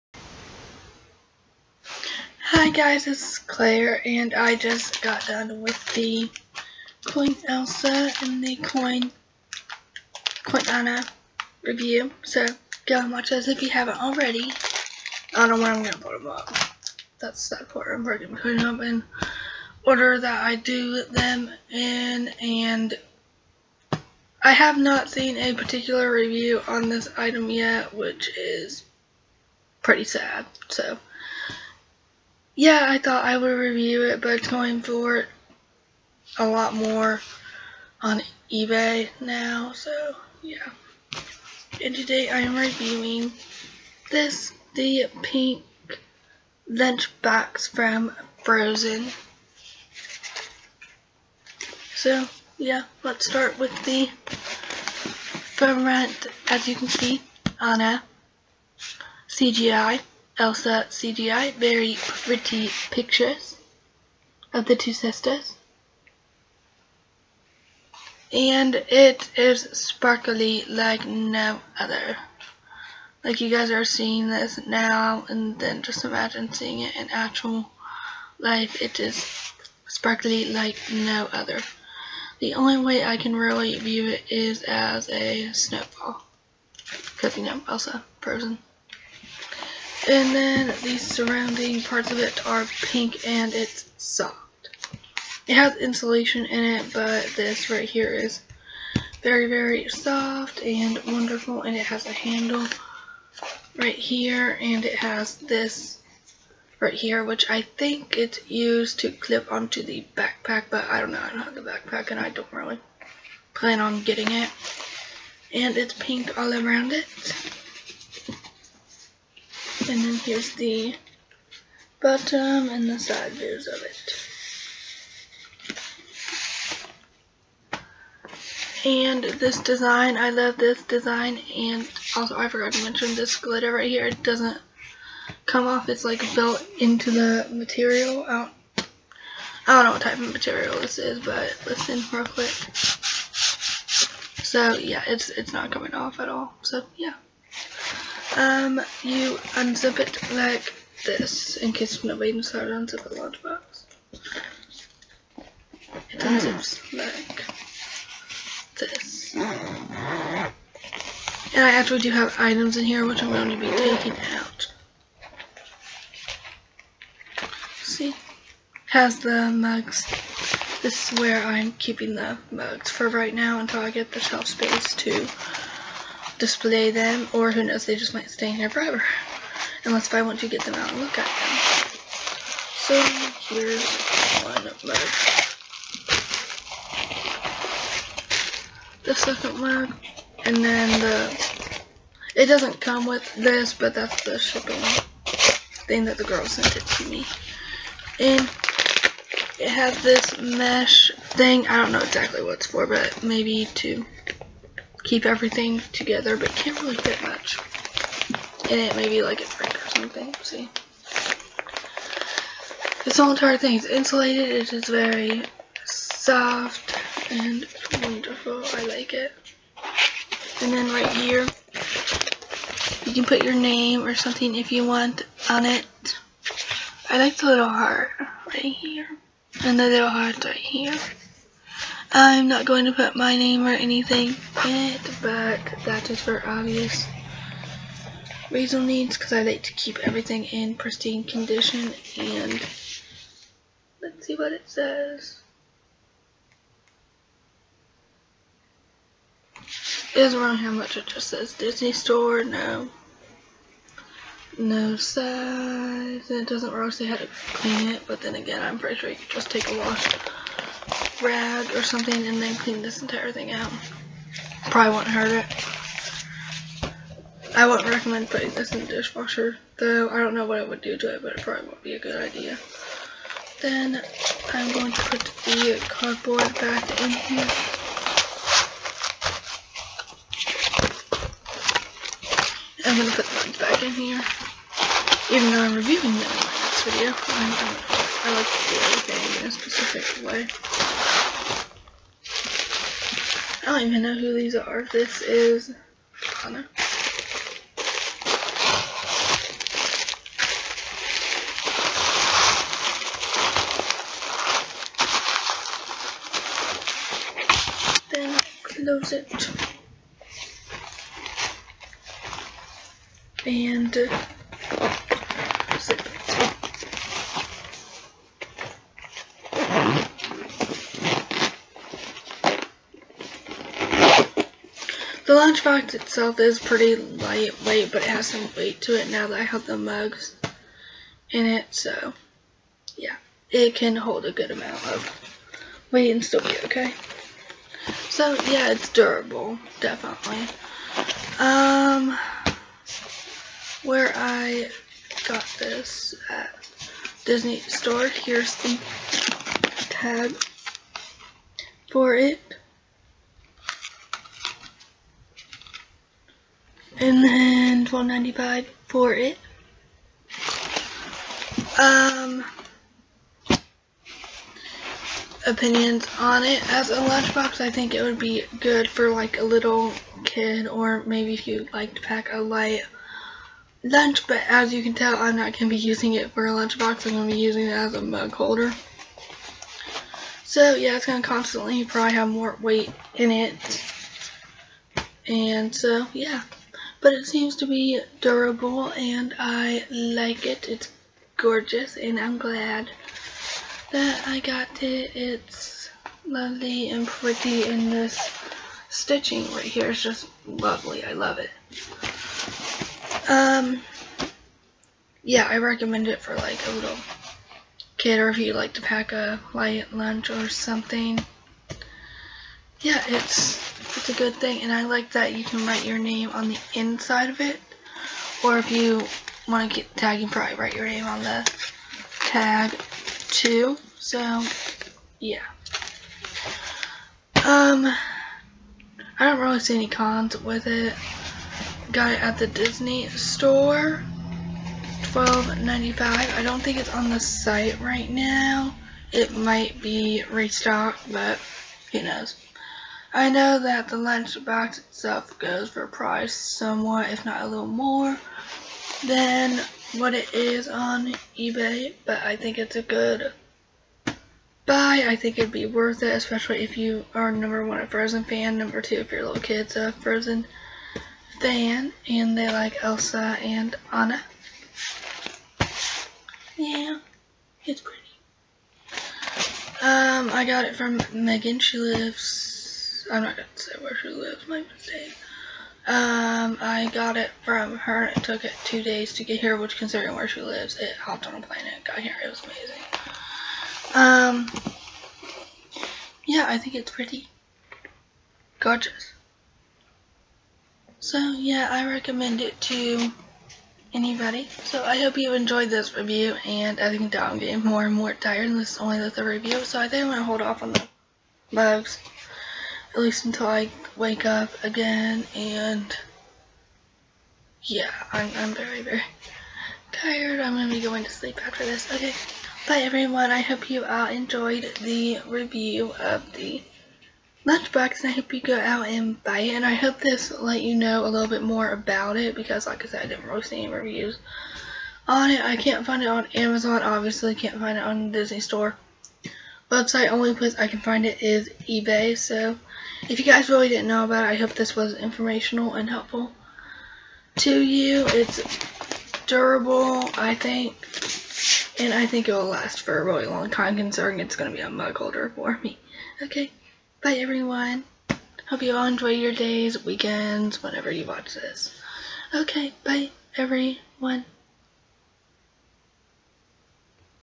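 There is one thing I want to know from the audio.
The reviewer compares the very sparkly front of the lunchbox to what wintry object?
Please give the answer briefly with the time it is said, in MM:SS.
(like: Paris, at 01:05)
A snowball, at 01:25.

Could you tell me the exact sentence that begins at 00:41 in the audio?
And today I am reviewing this, the pink lunchbox from Frozen.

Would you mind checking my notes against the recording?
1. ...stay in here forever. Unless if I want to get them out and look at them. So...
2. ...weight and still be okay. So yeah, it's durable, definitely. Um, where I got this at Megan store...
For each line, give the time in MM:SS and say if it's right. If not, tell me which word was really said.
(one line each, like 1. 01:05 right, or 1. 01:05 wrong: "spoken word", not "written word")
1. 02:58 right
2. 05:35 wrong: "Disney", not "Megan".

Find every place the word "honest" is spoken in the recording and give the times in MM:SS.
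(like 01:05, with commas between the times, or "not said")
not said.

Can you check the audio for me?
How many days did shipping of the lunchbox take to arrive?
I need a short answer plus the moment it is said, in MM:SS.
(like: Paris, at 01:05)
2, at 07:58.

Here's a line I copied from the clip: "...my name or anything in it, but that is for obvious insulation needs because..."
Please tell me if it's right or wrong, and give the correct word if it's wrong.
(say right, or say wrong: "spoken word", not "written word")
wrong: "reason", not "insulation".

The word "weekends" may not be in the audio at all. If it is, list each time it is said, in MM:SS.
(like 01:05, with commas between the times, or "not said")
09:09.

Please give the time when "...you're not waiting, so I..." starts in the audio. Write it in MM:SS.
02:32.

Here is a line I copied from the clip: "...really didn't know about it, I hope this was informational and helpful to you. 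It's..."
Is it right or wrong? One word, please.
right.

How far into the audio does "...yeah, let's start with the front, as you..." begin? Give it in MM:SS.
00:52.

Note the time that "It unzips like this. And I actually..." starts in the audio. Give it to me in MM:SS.
02:36.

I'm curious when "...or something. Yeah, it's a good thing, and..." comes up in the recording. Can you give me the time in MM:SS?
06:50.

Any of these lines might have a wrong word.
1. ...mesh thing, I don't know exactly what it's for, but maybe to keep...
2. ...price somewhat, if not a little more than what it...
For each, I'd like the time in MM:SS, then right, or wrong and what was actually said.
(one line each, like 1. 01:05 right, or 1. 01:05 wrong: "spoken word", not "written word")
1. 03:20 right
2. 07:25 right.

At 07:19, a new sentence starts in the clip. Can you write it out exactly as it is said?
It might be restocked, but who knows.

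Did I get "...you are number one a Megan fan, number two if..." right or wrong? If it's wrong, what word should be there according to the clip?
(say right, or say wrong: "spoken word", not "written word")
wrong: "Frozen", not "Megan".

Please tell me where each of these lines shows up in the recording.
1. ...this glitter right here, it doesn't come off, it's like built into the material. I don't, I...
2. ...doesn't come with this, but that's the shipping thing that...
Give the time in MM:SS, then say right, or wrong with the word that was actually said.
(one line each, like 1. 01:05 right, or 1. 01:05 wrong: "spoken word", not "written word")
1. 02:13 right
2. 03:12 right.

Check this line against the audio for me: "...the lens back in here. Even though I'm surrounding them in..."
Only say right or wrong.
wrong.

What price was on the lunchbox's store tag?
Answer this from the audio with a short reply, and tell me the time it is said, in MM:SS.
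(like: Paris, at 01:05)
$12.95, at 05:57.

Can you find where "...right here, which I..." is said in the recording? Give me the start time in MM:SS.
01:46.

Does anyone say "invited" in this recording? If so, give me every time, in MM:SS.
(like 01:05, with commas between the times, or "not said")
not said.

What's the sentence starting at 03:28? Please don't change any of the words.
Maybe like a drink or something.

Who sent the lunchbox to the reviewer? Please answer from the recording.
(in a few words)
Megan.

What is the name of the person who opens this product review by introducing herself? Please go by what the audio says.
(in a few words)
Clare.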